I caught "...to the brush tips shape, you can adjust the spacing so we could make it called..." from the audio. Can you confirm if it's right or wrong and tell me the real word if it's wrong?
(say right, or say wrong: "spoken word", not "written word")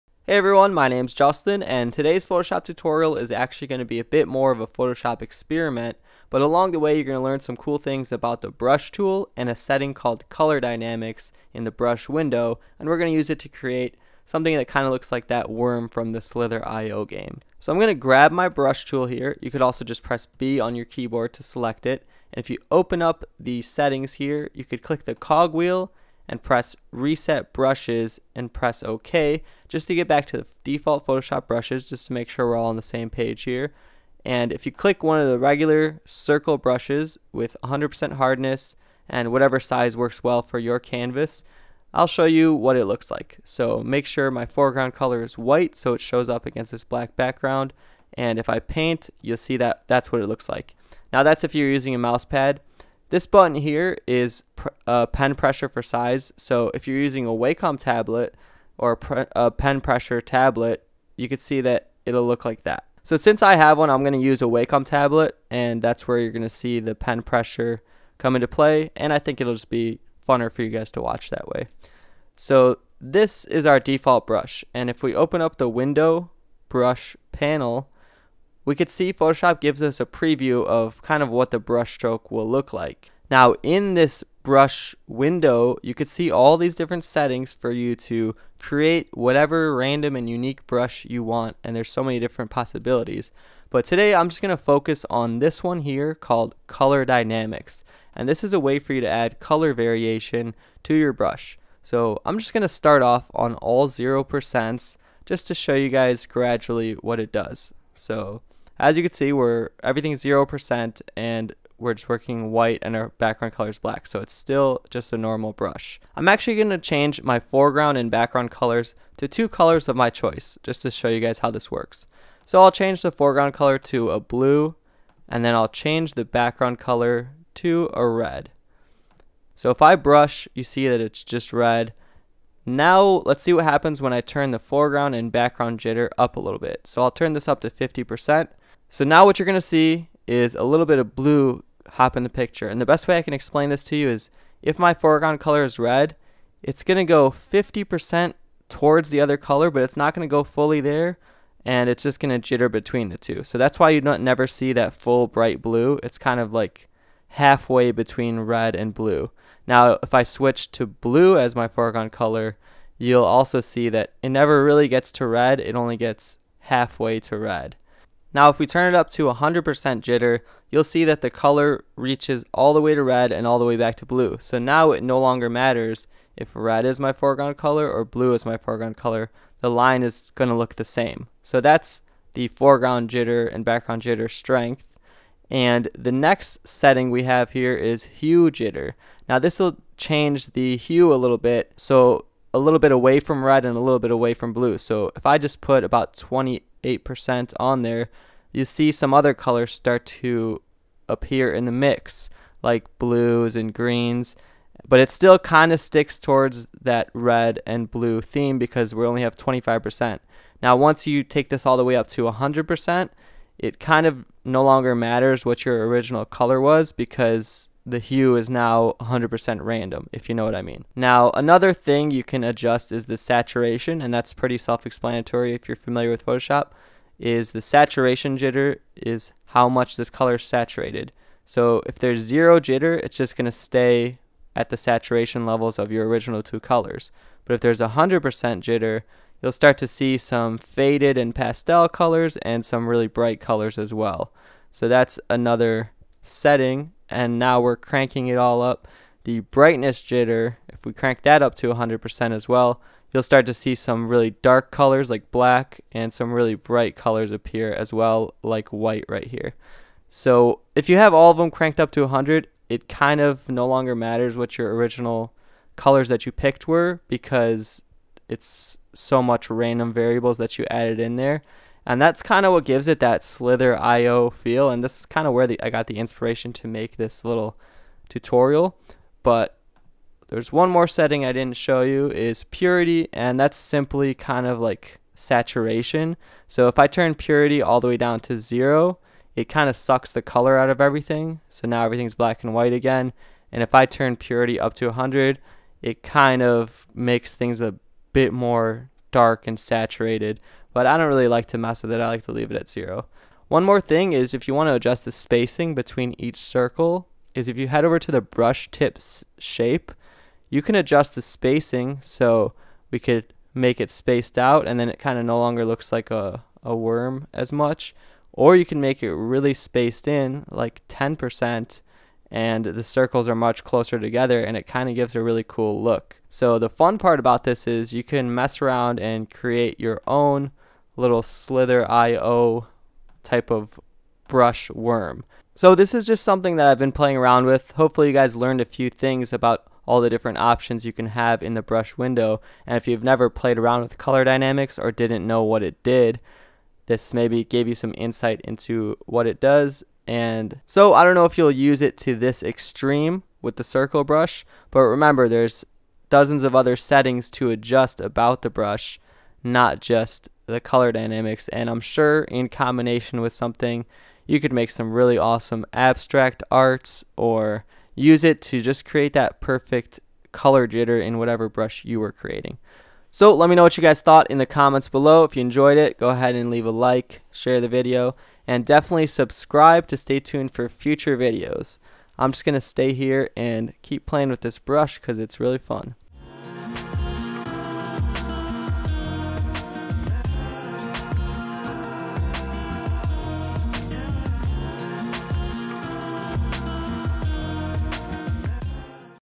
wrong: "spaced", not "called".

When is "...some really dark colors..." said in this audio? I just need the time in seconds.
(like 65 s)
253 s.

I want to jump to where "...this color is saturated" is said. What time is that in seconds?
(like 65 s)
229 s.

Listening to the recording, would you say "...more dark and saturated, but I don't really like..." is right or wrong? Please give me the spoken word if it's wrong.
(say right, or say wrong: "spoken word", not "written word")
right.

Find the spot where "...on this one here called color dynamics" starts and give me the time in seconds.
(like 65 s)
95 s.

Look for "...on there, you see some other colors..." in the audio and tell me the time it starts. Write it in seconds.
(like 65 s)
197 s.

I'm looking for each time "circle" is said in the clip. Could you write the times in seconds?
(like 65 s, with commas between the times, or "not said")
36 s, 306 s, 322 s, 353 s.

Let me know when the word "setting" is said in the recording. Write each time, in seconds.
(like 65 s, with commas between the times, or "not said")
9 s, 23 s, 87 s, 186 s, 246 s, 280 s, 356 s.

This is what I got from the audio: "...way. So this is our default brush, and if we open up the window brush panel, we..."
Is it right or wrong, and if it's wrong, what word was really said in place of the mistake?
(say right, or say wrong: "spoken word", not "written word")
right.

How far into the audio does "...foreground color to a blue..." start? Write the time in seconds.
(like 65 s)
123 s.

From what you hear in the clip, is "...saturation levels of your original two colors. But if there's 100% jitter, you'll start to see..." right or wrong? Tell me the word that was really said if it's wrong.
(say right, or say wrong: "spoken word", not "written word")
right.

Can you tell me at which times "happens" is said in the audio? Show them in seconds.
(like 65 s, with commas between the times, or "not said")
133 s.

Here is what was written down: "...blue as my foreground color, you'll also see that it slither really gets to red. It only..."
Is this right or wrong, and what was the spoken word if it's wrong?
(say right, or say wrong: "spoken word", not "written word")
wrong: "never", not "slither".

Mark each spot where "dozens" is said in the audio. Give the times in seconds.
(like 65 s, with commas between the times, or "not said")
356 s.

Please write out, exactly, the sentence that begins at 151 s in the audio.
And it's just going to jitter between the two.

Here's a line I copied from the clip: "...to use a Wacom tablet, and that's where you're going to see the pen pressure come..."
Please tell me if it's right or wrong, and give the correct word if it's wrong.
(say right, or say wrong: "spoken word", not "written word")
right.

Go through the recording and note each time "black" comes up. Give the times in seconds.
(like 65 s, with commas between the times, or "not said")
46 s, 113 s, 255 s, 292 s.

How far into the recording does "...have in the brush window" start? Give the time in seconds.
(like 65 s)
341 s.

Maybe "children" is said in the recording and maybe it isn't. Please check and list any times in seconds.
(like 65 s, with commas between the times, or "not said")
not said.